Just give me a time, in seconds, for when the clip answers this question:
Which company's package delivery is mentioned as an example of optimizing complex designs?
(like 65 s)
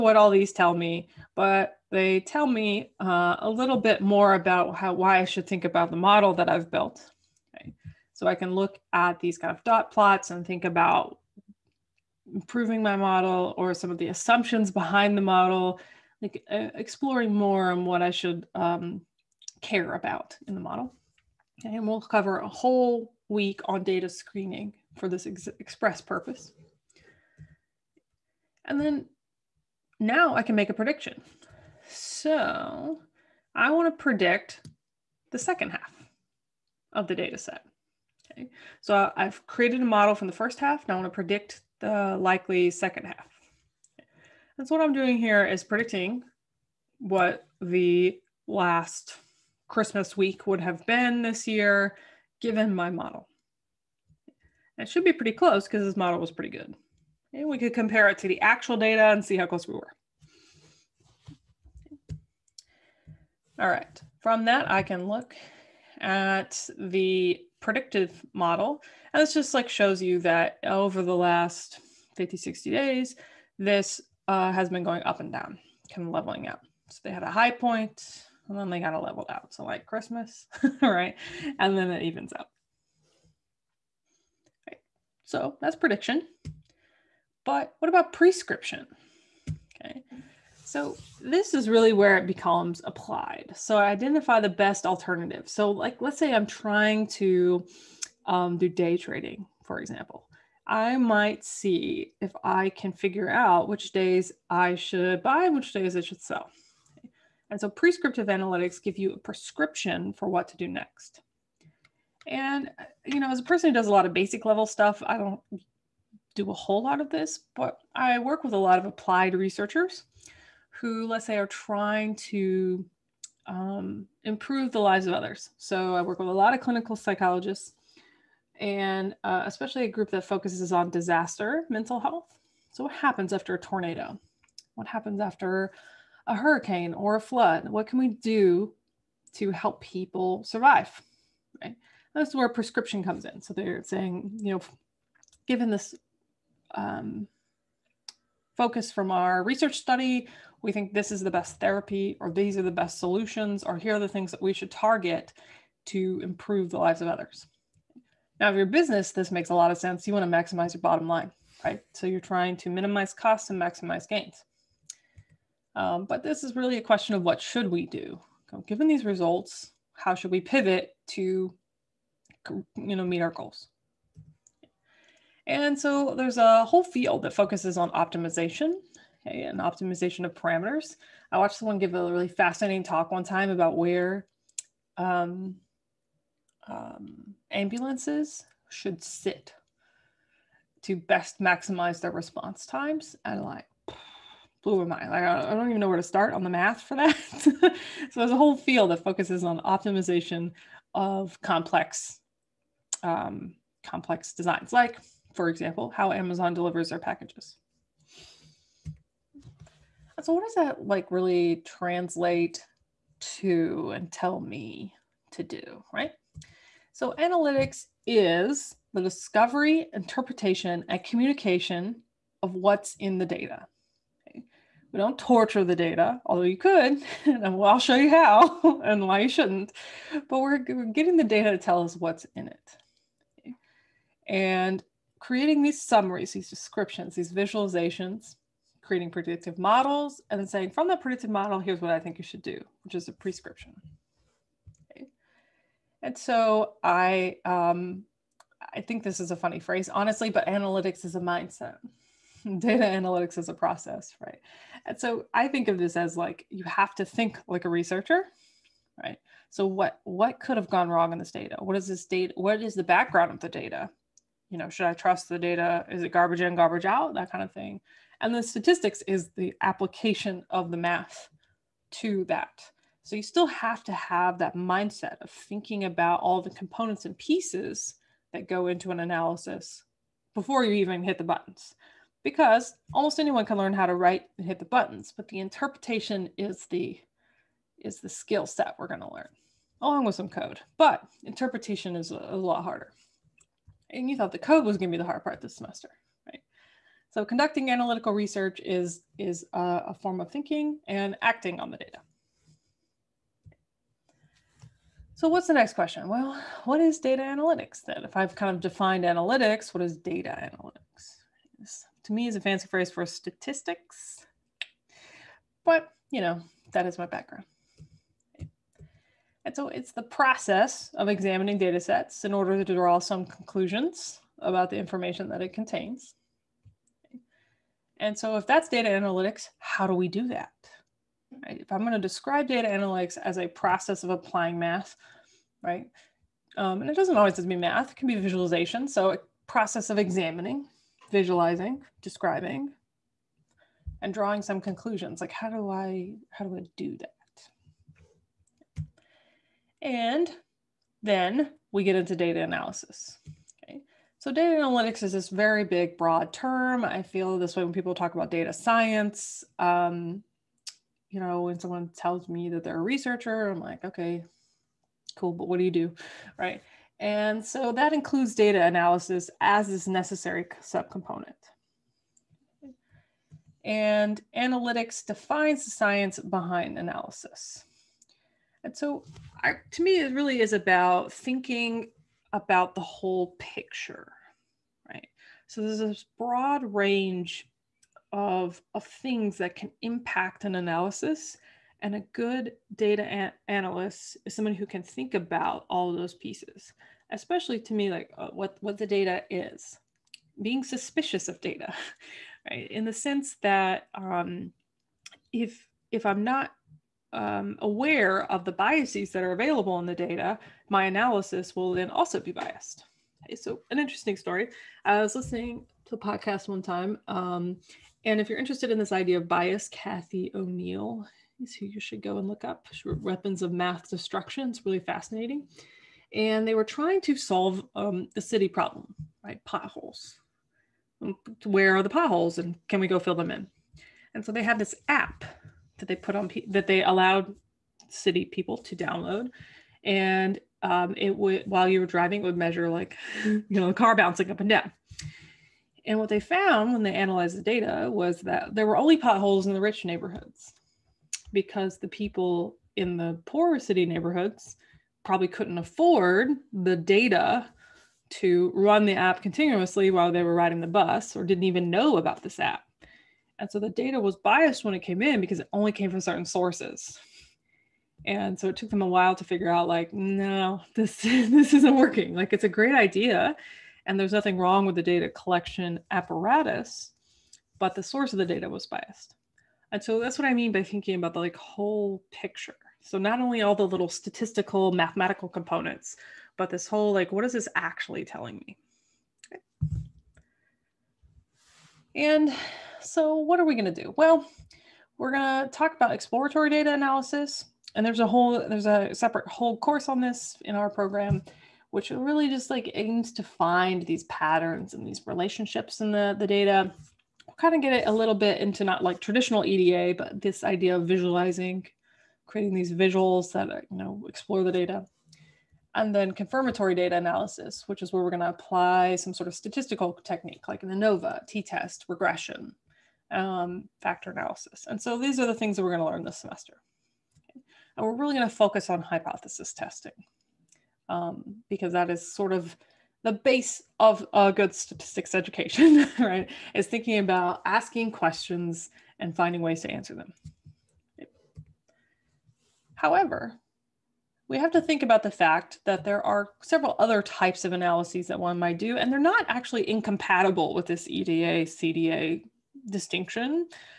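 206 s.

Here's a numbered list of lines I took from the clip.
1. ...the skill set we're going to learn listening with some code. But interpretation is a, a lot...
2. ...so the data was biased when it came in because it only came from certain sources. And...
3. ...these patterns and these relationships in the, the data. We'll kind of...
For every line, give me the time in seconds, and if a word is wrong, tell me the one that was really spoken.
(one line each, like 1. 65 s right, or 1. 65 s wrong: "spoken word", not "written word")
1. 288 s wrong: "along", not "listening"
2. 463 s right
3. 503 s right.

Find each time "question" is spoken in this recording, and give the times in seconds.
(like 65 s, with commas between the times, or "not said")
166 s, 305 s, 537 s.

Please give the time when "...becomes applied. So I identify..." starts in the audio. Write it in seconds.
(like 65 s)
92 s.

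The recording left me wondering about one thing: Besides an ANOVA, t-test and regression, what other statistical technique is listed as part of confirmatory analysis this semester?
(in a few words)
Factor analysis.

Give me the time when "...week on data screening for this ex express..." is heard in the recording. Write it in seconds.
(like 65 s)
23 s.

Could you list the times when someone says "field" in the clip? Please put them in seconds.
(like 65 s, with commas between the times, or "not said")
176 s, 198 s.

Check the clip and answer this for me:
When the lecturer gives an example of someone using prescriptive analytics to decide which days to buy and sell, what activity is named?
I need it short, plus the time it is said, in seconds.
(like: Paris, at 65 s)
Day trading, at 98 s.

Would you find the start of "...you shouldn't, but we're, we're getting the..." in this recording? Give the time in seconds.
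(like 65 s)
229 s.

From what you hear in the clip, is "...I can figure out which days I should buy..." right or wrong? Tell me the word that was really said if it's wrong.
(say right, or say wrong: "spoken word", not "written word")
right.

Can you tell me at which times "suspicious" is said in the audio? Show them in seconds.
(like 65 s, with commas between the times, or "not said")
400 s.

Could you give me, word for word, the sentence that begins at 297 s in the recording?
So conducting analytical research is, is a, a form of thinking and acting on the data.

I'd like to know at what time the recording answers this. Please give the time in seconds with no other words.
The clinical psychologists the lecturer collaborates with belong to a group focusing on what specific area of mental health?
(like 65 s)
130 s.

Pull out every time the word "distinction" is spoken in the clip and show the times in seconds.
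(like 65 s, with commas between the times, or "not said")
552 s.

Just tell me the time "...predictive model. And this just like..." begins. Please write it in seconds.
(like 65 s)
67 s.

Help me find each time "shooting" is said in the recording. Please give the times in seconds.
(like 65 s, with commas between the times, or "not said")
not said.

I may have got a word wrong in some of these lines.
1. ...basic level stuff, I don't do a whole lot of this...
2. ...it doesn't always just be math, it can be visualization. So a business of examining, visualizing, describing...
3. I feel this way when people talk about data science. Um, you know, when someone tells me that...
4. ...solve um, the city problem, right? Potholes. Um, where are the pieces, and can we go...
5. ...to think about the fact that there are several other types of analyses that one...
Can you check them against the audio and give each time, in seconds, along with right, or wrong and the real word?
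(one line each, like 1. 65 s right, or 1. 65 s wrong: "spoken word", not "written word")
1. 114 s right
2. 336 s wrong: "process", not "business"
3. 356 s right
4. 427 s wrong: "potholes", not "pieces"
5. 544 s right.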